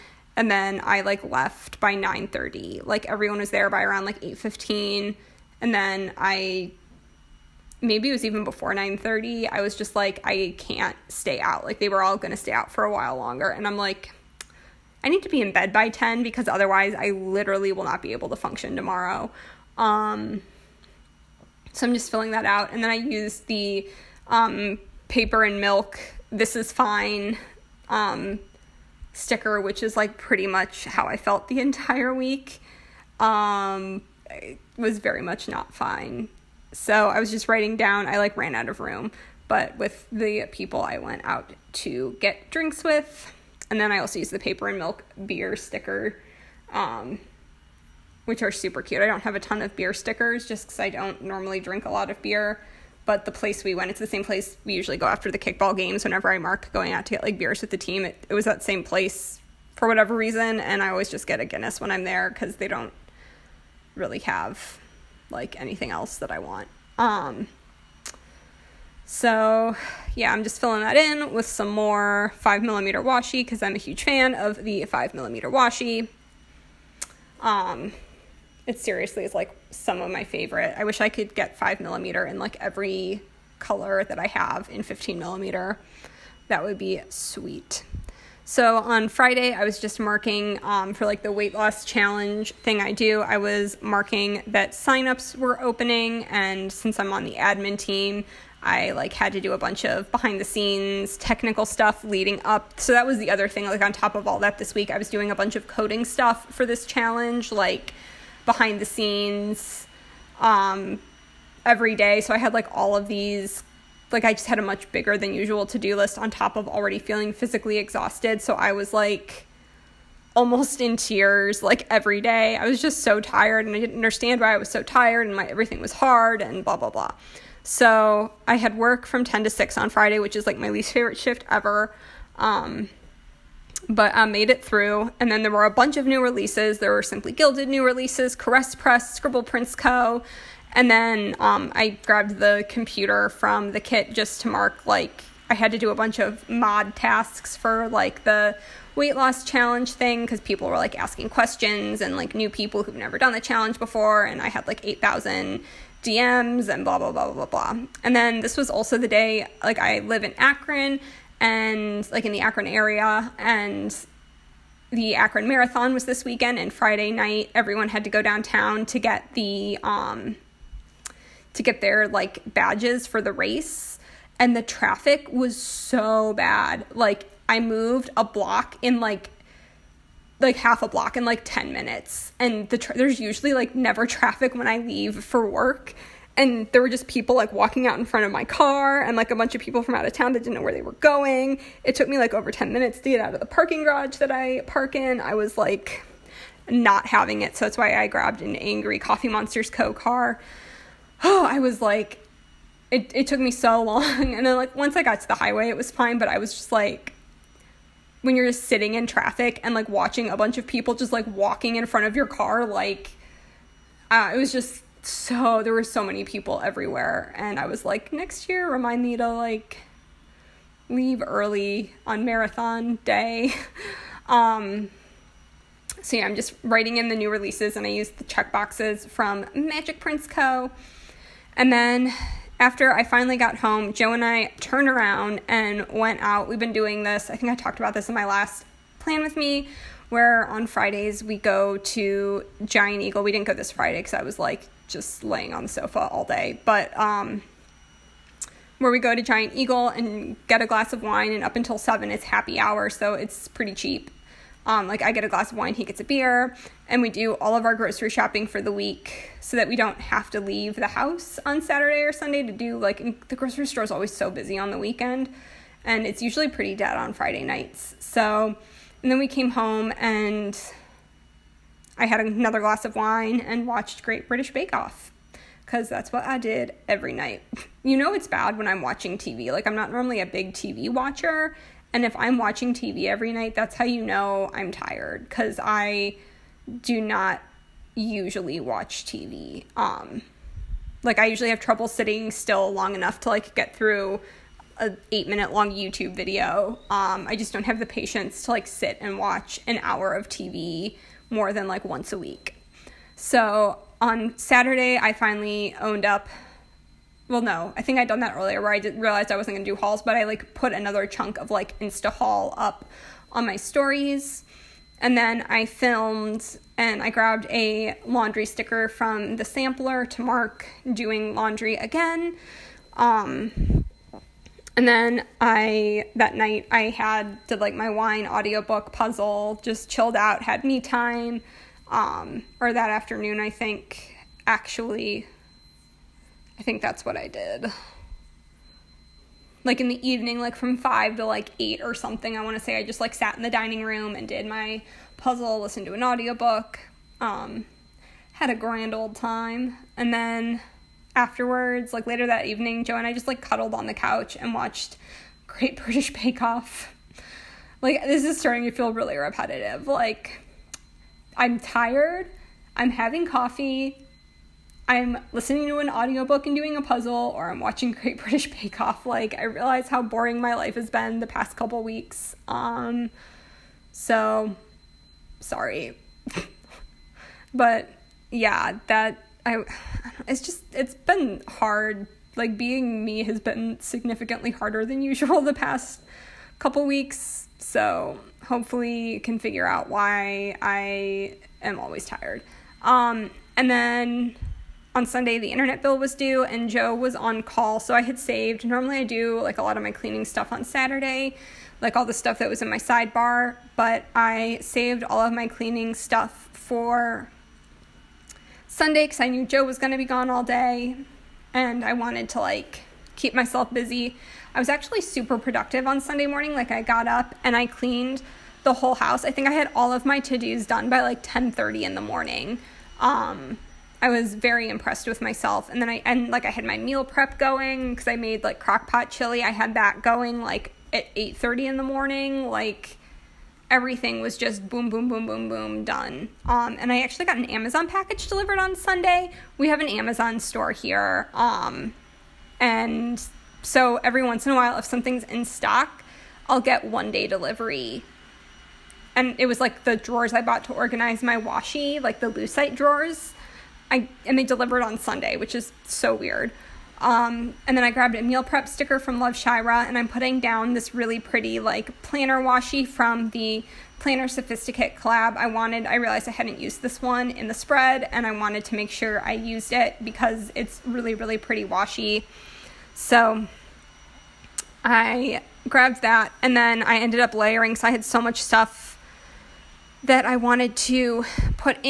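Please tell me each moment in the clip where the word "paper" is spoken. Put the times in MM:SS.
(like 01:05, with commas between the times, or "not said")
00:25, 00:44.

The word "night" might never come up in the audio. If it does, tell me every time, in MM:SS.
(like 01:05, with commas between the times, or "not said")
02:47, 04:27, 04:37, 04:43, 05:26.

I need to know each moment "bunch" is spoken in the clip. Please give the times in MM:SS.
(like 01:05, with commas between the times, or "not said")
01:39, 01:45, 02:15, 02:25, 03:09, 03:30.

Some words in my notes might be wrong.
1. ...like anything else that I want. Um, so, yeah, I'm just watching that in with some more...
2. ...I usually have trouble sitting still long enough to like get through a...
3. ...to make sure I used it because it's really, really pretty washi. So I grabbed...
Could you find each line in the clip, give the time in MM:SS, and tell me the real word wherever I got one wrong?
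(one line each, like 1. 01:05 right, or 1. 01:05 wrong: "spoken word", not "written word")
1. 01:05 wrong: "filling", not "watching"
2. 04:51 right
3. 07:48 right.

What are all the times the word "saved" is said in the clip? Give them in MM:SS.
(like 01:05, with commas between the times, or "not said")
06:38, 06:44.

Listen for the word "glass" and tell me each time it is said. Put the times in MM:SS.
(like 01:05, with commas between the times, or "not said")
04:10, 04:15, 04:32.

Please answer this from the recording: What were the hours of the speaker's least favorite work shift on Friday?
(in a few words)
10 to 6.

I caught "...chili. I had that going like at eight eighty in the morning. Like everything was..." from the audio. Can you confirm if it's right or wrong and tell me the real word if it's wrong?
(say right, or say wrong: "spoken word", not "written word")
wrong: "thirty", not "eighty".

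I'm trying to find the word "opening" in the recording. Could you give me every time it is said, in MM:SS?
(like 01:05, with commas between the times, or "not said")
01:35.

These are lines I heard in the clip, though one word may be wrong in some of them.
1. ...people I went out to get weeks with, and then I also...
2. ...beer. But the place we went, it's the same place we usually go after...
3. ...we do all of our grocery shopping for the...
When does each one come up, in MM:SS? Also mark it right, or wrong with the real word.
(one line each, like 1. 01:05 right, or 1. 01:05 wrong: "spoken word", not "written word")
1. 00:40 wrong: "drinks", not "weeks"
2. 00:52 right
3. 04:17 right.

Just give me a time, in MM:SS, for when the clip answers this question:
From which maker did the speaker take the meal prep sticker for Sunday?
07:39.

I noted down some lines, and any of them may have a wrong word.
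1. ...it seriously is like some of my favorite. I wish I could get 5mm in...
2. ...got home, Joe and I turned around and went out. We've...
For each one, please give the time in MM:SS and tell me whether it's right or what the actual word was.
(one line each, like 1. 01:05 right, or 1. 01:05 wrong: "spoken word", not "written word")
1. 01:18 right
2. 03:53 right.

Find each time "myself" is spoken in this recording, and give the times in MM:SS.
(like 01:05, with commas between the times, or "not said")
06:53, 07:05.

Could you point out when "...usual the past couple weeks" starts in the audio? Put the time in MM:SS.
06:25.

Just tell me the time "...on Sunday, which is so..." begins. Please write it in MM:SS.
07:34.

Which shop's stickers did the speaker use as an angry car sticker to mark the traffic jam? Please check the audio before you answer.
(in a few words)
Coffee Monsterz Co.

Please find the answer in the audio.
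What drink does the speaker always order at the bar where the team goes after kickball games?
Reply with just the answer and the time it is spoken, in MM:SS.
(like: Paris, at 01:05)
Guinness, at 01:01.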